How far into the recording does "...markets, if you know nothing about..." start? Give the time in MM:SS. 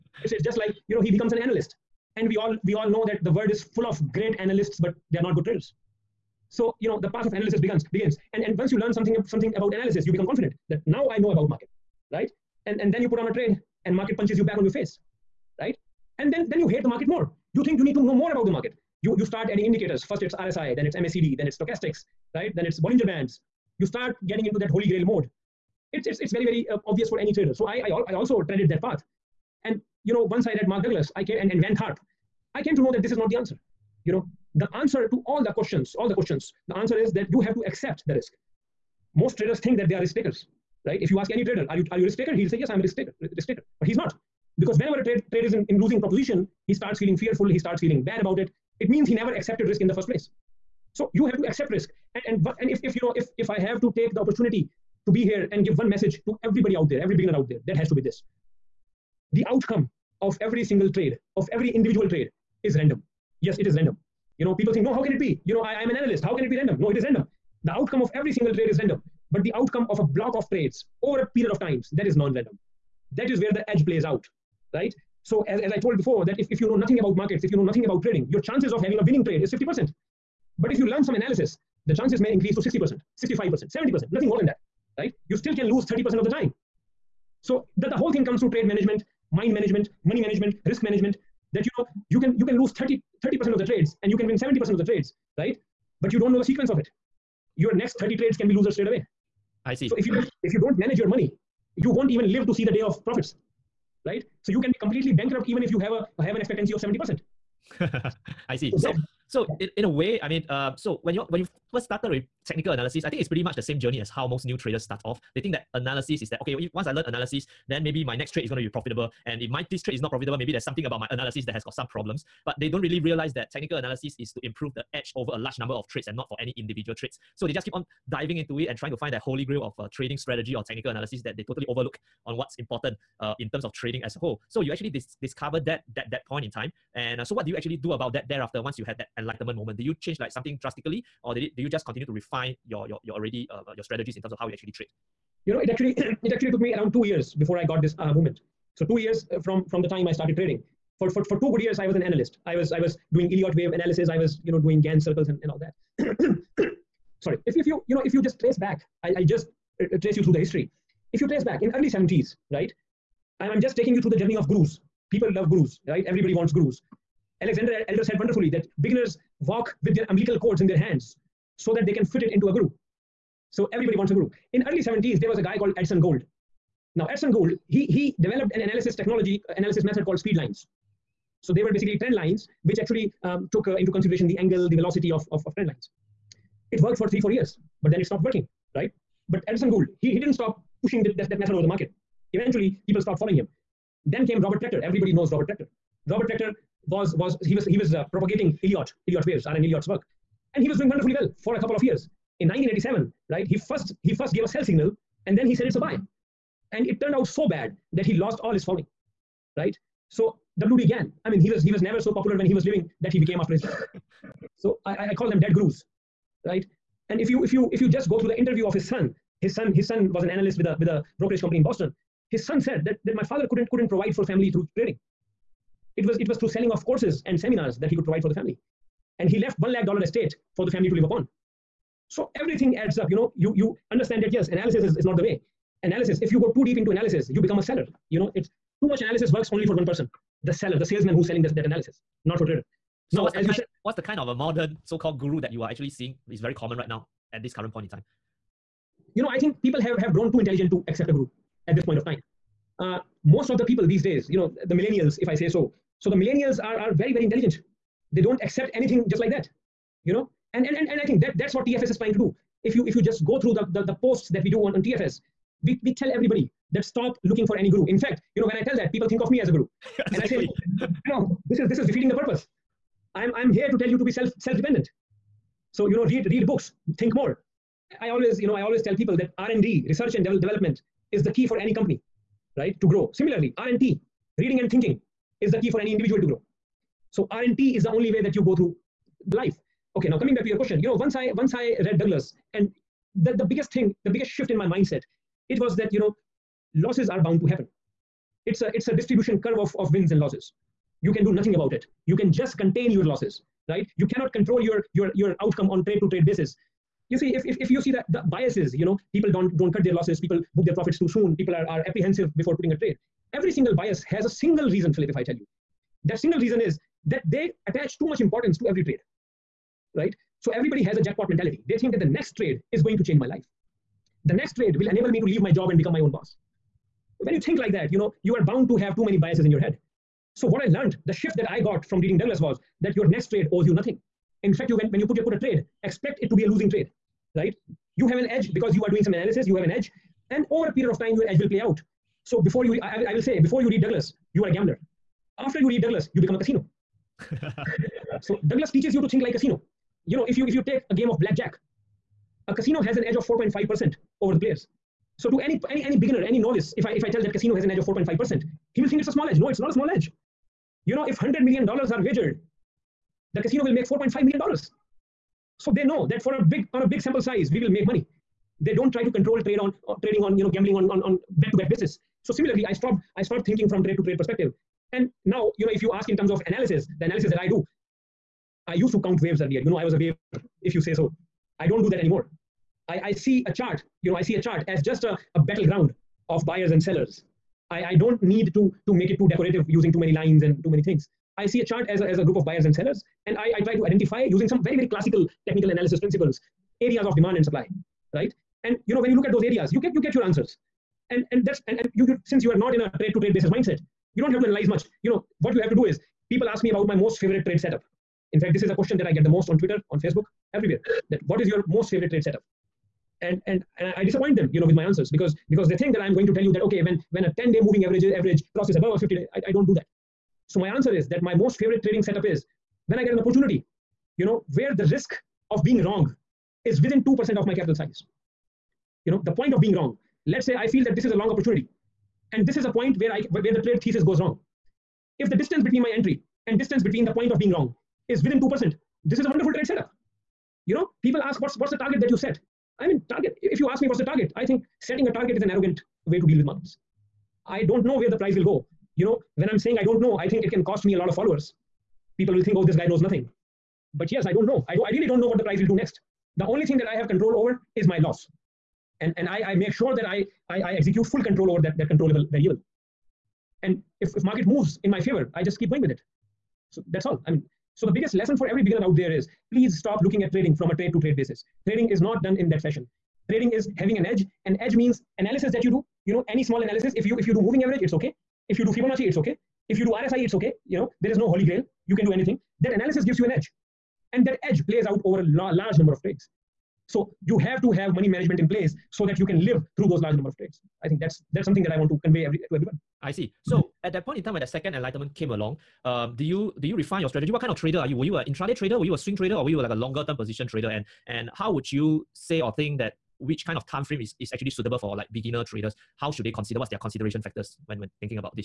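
01:17.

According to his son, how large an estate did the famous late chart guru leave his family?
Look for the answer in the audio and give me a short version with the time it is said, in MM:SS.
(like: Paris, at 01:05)
1 lakh dollars, at 03:49.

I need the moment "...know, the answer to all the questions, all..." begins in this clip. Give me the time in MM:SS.
00:34.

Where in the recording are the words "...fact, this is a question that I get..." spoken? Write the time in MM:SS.
06:48.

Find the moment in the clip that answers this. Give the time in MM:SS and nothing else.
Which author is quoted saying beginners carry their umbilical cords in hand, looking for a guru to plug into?
02:47.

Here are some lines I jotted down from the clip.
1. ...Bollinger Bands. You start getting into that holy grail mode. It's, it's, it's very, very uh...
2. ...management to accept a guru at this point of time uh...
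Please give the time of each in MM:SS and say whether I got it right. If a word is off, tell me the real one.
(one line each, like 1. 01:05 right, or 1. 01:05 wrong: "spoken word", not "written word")
1. 00:22 right
2. 04:10 wrong: "intelligent", not "management".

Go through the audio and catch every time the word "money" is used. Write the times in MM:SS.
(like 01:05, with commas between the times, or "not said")
01:30, 01:41, 06:07, 08:07.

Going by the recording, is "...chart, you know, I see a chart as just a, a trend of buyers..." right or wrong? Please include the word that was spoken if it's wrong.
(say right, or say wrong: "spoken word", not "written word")
wrong: "battleground", not "trend".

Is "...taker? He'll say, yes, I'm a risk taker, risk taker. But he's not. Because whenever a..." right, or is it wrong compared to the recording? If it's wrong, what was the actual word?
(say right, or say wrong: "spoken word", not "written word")
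right.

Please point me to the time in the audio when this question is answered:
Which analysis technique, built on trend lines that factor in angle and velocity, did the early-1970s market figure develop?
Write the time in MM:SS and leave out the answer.
03:00.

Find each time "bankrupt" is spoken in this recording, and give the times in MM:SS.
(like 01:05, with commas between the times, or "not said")
01:45.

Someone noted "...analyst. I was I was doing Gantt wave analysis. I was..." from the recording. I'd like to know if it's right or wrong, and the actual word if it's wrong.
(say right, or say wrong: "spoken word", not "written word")
wrong: "Elliott", not "Gantt".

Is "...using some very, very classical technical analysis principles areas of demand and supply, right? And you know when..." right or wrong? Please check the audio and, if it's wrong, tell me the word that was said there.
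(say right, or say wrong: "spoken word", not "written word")
right.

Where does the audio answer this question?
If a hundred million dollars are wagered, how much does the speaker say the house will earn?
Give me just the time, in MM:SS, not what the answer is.
06:03.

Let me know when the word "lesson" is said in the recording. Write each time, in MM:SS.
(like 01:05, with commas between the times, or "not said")
07:48.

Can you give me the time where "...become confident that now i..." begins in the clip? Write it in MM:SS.
00:10.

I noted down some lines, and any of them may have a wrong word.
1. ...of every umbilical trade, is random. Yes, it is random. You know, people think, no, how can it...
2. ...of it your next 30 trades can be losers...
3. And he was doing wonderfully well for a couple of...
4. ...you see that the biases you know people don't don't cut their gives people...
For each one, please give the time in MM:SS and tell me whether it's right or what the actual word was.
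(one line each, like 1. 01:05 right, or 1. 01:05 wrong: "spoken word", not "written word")
1. 01:01 wrong: "individual", not "umbilical"
2. 01:36 right
3. 03:20 right
4. 05:07 wrong: "losses", not "gives".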